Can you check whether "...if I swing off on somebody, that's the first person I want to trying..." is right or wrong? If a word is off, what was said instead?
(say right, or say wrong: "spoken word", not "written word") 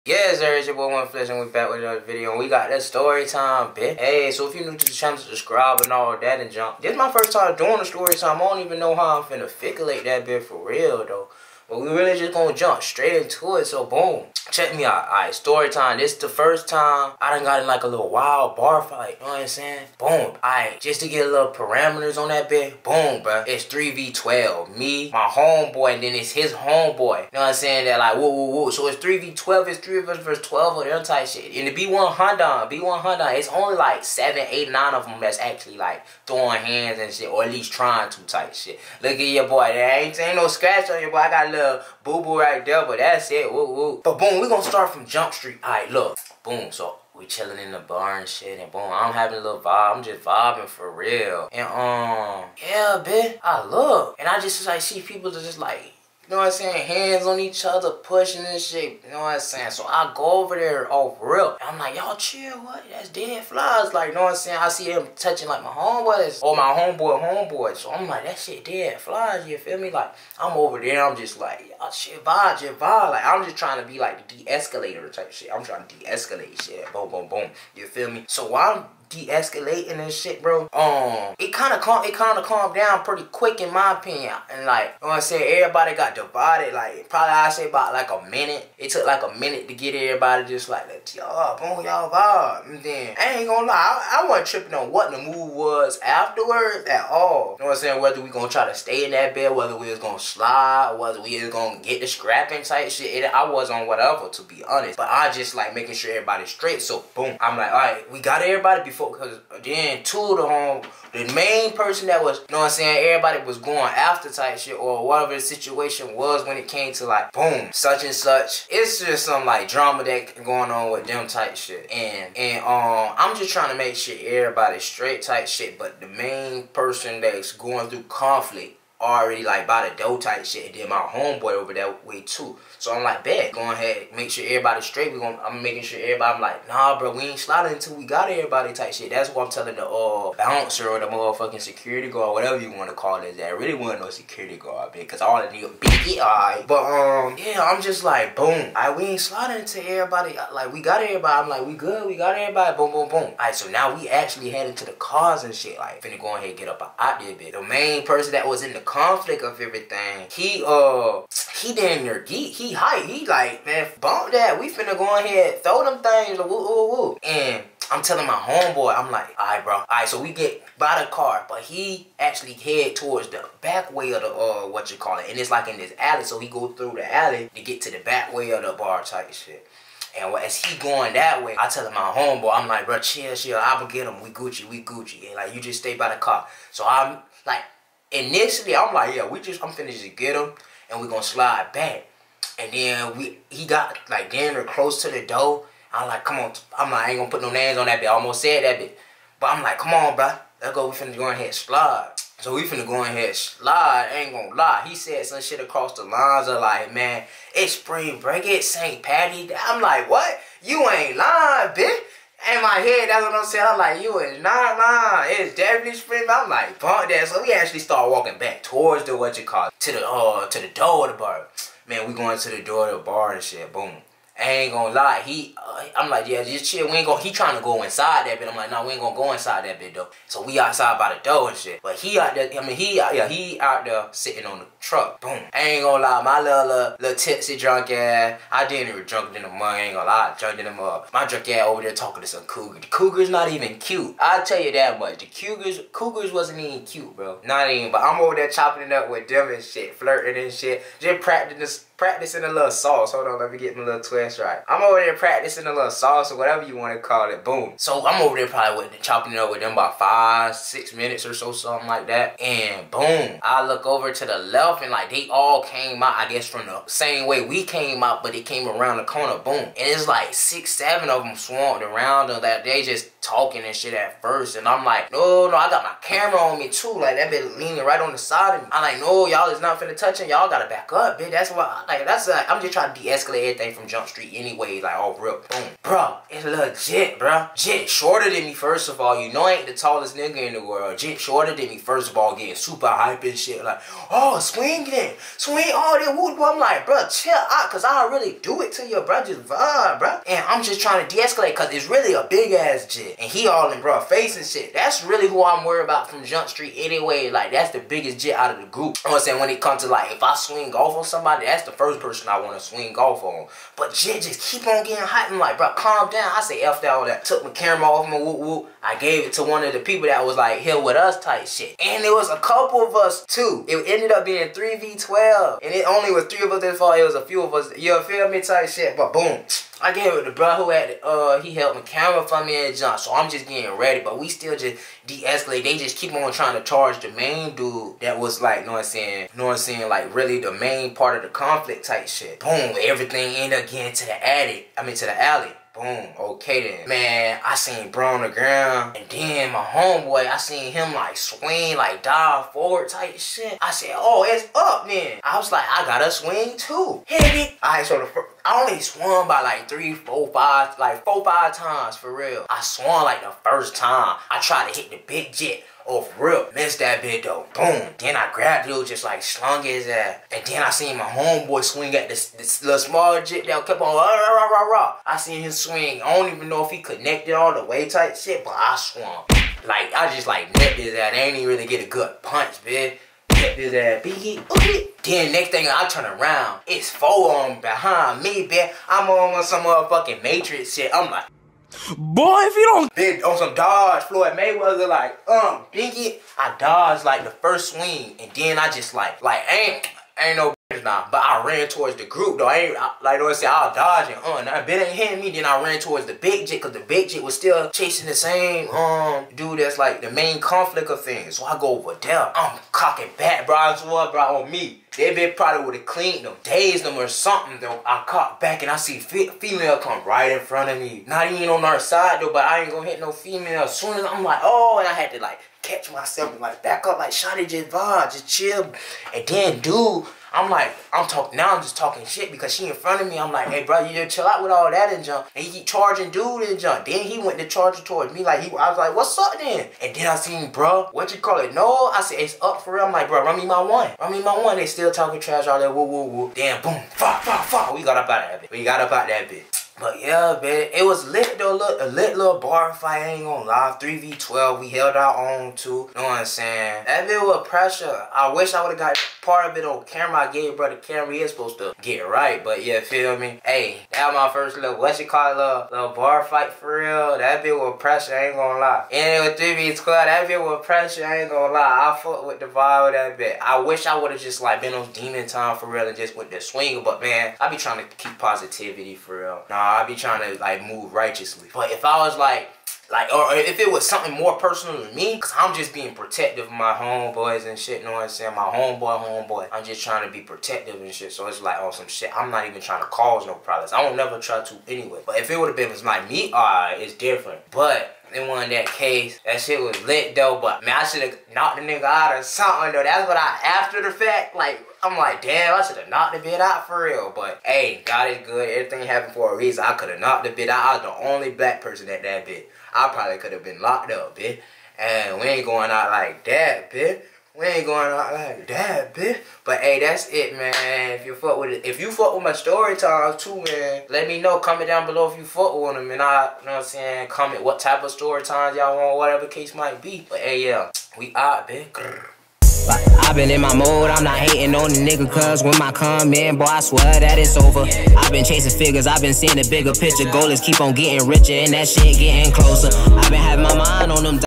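wrong: "swing", not "trying".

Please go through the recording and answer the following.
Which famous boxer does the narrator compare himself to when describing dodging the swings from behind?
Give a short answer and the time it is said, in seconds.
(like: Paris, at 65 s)
Floyd Mayweather, at 394 s.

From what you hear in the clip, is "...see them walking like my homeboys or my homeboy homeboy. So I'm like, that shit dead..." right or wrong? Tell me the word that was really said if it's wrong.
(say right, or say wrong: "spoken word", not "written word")
wrong: "touching", not "walking".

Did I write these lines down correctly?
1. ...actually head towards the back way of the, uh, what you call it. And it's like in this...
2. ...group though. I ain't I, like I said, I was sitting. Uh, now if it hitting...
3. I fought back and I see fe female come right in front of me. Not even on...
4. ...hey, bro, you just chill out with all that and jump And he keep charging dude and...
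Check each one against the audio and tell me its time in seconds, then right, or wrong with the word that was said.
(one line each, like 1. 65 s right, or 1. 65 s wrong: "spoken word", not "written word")
1. 172 s right
2. 402 s wrong: "dodging", not "sitting"
3. 417 s wrong: "caught", not "fought"
4. 433 s right.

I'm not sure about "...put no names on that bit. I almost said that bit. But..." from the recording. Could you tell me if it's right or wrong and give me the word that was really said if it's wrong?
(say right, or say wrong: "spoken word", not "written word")
right.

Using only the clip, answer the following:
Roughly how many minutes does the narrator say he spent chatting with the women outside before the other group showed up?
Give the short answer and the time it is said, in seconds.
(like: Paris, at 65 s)
5 or 6 minutes, at 259 s.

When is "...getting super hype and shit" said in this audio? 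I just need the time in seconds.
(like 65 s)
292 s.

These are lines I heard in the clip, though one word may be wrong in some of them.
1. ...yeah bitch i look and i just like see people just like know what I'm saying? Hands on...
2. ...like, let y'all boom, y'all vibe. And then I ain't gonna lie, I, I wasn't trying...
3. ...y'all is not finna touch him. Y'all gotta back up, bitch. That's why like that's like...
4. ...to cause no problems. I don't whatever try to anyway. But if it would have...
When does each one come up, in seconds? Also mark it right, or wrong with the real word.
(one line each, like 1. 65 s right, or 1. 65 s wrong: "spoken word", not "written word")
1. 52 s right
2. 90 s wrong: "tripping", not "trying"
3. 279 s right
4. 492 s wrong: "never", not "whatever".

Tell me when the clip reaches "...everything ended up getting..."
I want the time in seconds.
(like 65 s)
342 s.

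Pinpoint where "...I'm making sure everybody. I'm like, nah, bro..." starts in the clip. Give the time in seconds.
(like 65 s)
135 s.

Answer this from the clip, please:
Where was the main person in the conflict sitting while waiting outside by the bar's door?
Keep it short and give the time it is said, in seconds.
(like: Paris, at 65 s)
on the truck, at 234 s.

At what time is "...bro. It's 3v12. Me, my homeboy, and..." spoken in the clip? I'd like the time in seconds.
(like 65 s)
23 s.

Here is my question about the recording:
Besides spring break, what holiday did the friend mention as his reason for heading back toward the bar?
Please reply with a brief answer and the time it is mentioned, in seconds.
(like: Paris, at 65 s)
St. Patty's, at 208 s.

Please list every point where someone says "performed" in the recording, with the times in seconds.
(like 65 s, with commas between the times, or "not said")
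not said.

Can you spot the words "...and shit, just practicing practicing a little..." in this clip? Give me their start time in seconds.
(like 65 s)
250 s.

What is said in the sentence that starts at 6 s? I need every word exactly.
This is my first time doing the story time.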